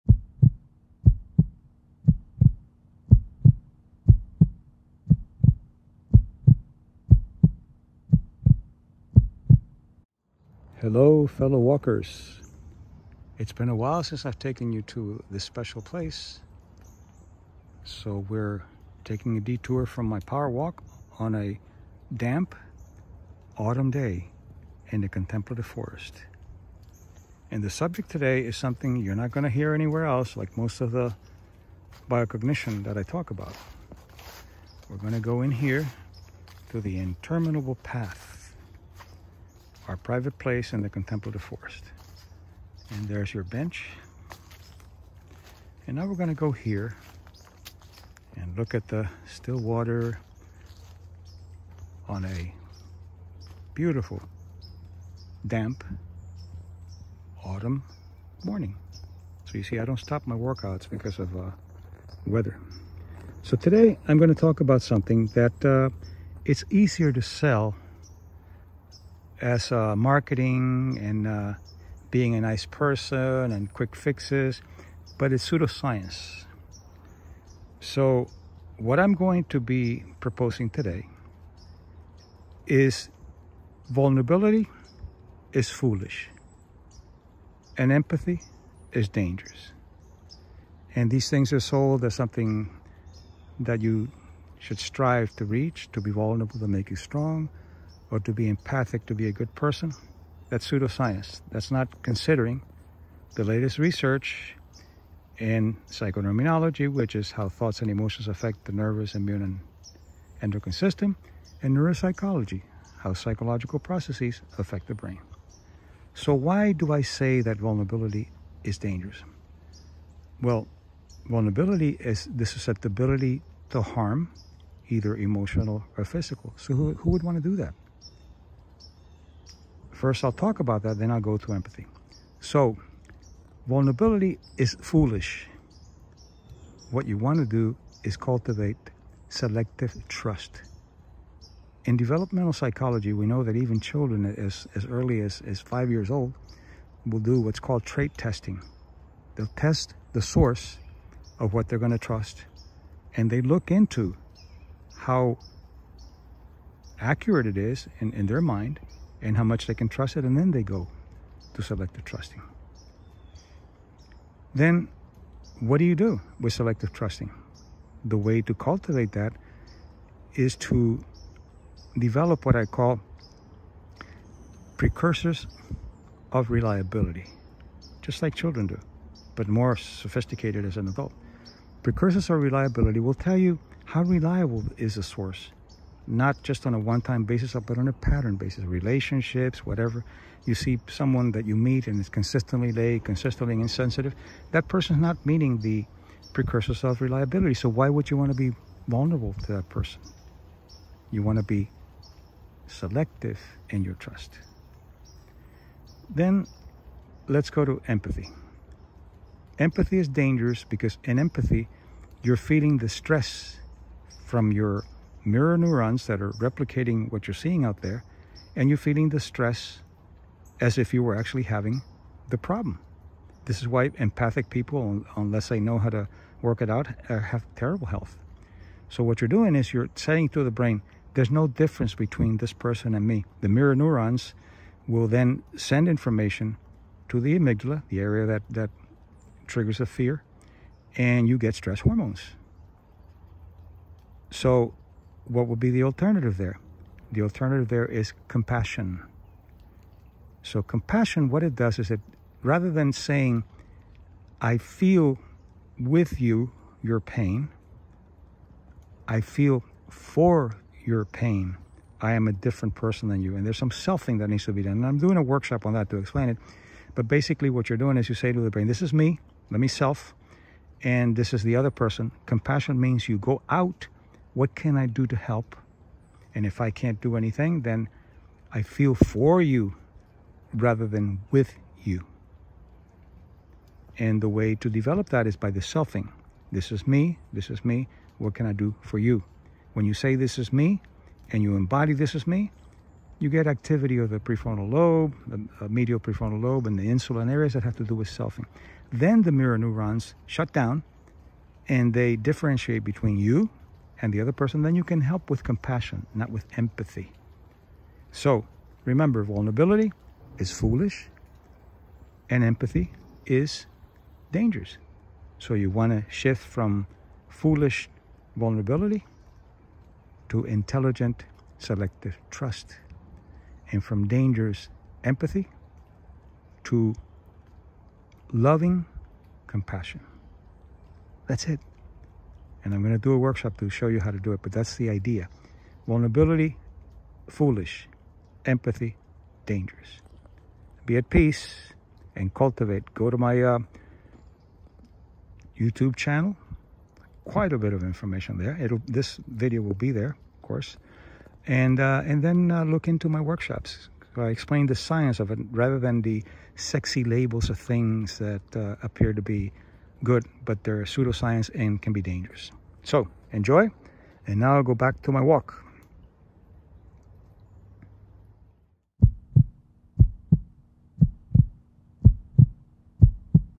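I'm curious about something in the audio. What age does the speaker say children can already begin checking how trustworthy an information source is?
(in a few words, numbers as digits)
5.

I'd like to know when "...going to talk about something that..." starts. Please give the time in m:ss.
1:04.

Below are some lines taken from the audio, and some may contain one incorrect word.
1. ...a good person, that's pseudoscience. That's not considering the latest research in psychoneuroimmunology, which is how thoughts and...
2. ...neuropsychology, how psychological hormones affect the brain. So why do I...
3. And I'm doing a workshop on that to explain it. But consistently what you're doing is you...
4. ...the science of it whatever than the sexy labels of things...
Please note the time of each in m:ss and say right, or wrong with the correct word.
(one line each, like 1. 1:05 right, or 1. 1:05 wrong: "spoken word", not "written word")
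1. 1:39 right
2. 1:51 wrong: "processes", not "hormones"
3. 4:24 wrong: "basically", not "consistently"
4. 5:54 wrong: "rather", not "whatever".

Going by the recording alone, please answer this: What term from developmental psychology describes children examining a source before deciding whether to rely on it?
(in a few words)
trait testing.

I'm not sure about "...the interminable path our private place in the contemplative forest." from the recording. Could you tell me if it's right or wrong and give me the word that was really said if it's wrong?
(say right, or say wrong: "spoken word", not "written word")
right.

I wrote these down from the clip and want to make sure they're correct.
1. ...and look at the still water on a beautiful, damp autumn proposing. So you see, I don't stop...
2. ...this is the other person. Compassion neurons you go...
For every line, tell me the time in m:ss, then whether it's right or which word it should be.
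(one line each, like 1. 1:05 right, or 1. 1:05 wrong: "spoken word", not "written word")
1. 0:48 wrong: "morning", not "proposing"
2. 4:31 wrong: "means", not "neurons".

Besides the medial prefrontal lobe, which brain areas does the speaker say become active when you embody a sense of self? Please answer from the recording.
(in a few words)
insular areas.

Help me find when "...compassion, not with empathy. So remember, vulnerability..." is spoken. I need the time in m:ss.
5:05.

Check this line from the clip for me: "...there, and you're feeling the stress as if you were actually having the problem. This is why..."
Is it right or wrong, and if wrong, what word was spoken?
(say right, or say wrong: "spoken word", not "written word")
right.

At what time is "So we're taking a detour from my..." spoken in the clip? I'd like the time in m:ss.
0:17.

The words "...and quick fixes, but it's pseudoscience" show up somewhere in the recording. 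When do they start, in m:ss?
1:13.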